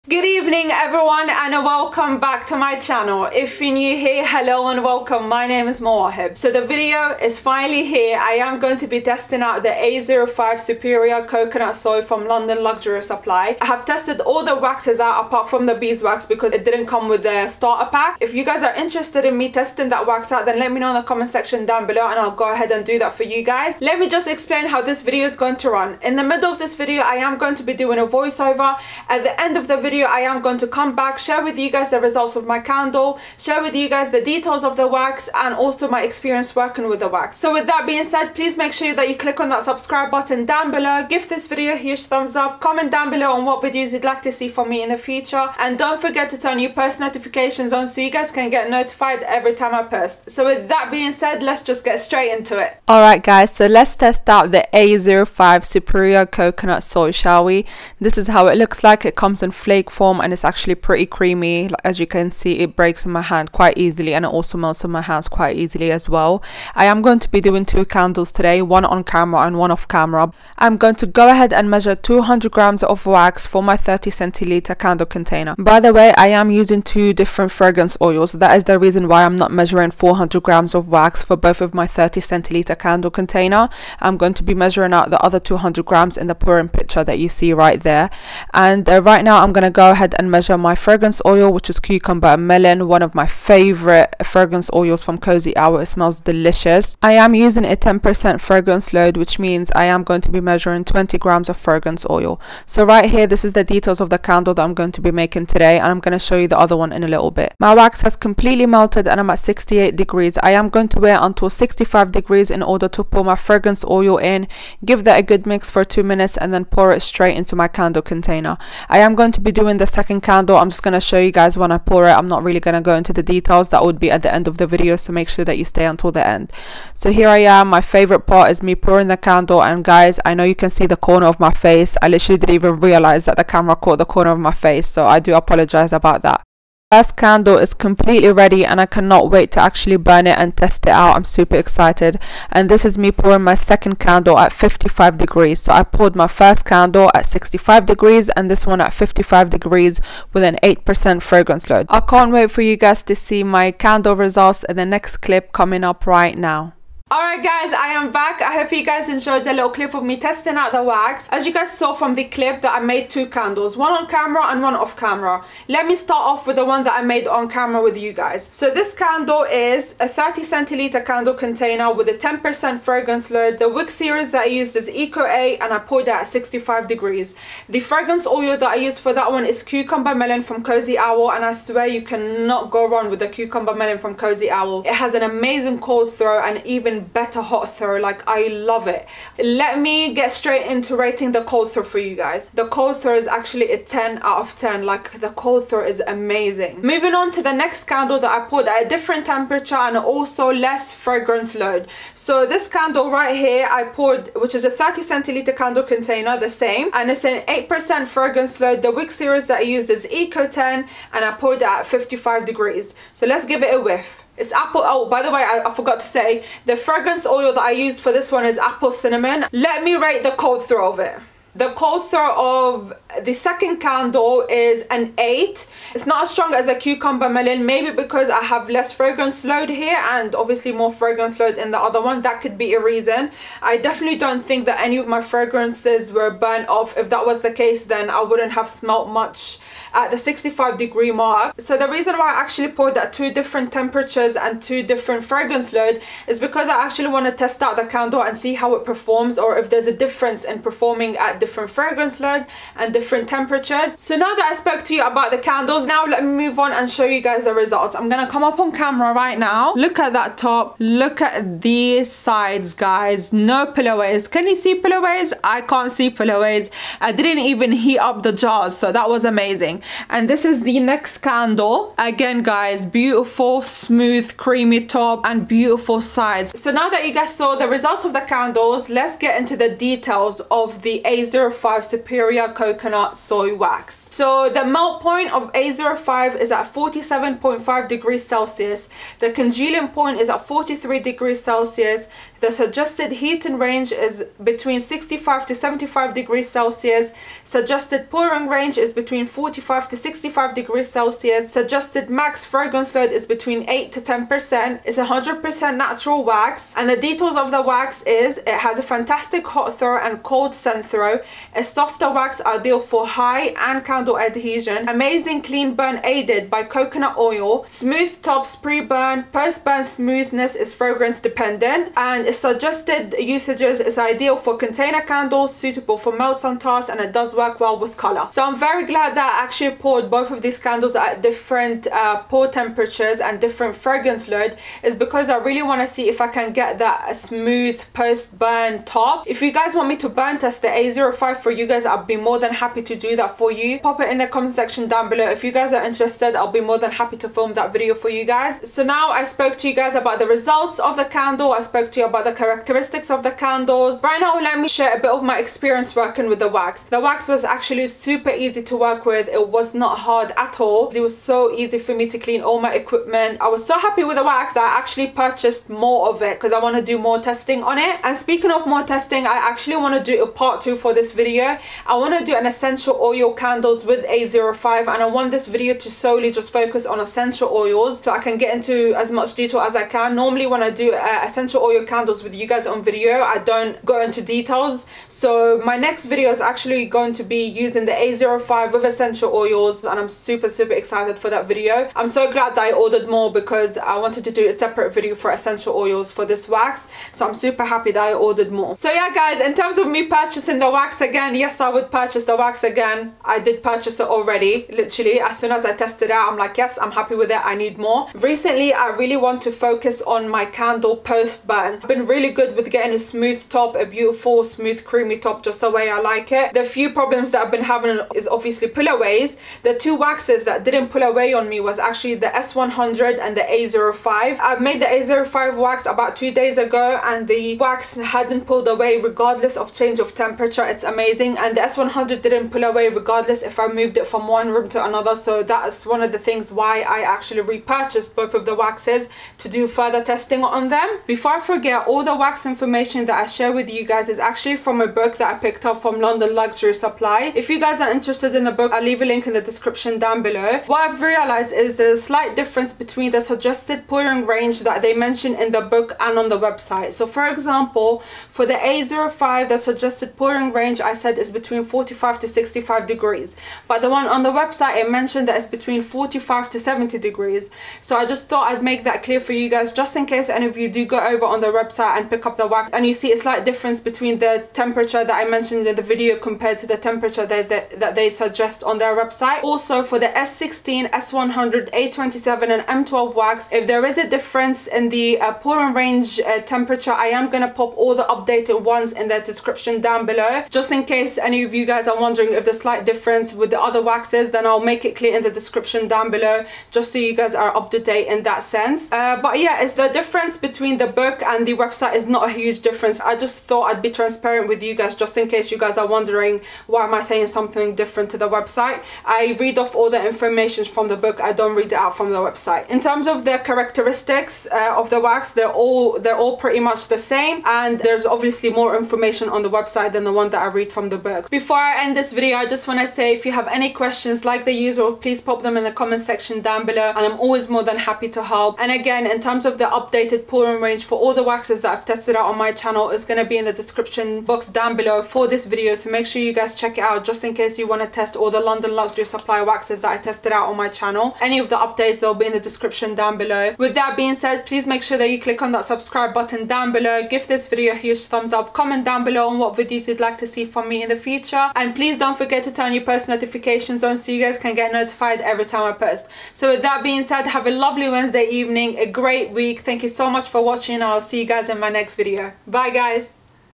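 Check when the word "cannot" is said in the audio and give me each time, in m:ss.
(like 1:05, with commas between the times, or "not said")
2:18, 3:02.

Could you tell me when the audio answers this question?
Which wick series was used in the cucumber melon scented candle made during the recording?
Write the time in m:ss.
2:54.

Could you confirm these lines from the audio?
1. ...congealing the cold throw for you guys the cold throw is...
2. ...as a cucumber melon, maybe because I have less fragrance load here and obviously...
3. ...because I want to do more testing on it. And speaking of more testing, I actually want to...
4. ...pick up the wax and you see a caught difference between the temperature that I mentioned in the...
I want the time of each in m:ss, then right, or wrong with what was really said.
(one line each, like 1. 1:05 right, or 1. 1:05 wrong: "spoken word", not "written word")
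1. 3:10 wrong: "rating", not "congealing"
2. 3:46 right
3. 6:06 right
4. 7:52 wrong: "slight", not "caught".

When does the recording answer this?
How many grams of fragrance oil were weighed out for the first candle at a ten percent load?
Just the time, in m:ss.
1:40.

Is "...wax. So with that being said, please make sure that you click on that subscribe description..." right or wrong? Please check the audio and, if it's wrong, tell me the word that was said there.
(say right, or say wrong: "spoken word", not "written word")
wrong: "button", not "description".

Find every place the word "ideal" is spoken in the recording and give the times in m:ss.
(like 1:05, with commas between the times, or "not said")
5:12, 5:23.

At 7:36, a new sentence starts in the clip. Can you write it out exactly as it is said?
So for example, for the A05, the suggested pouring range I said is between 45 to 65 degrees.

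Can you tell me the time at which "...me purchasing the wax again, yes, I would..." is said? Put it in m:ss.
6:39.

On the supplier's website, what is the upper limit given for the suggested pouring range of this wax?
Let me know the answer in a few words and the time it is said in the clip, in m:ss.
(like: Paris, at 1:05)
70 degrees, at 7:46.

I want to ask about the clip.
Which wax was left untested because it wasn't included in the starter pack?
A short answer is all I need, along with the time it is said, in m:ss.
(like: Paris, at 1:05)
Beeswax, at 0:15.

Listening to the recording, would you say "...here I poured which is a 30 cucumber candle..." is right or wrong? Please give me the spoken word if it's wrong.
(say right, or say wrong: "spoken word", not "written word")
wrong: "centiliter", not "cucumber".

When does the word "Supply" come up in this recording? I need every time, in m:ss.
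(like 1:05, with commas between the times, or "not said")
0:13, 7:26, 8:59.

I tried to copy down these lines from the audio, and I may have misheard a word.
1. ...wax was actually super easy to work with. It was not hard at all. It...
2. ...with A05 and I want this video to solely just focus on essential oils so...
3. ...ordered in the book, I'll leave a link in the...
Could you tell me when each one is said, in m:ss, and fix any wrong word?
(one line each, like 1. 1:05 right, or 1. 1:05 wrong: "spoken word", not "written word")
1. 5:56 right
2. 6:13 right
3. 7:27 wrong: "interested", not "ordered".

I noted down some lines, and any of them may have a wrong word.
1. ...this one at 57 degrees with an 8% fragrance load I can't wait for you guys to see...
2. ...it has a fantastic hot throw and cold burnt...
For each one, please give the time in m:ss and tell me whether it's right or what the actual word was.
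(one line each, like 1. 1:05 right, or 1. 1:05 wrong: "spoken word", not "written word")
1. 2:28 wrong: "55", not "57"
2. 5:08 wrong: "scent", not "burnt".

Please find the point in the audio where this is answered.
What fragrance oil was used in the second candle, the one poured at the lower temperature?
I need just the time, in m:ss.
3:38.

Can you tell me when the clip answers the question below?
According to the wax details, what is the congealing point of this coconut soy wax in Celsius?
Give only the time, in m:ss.
4:50.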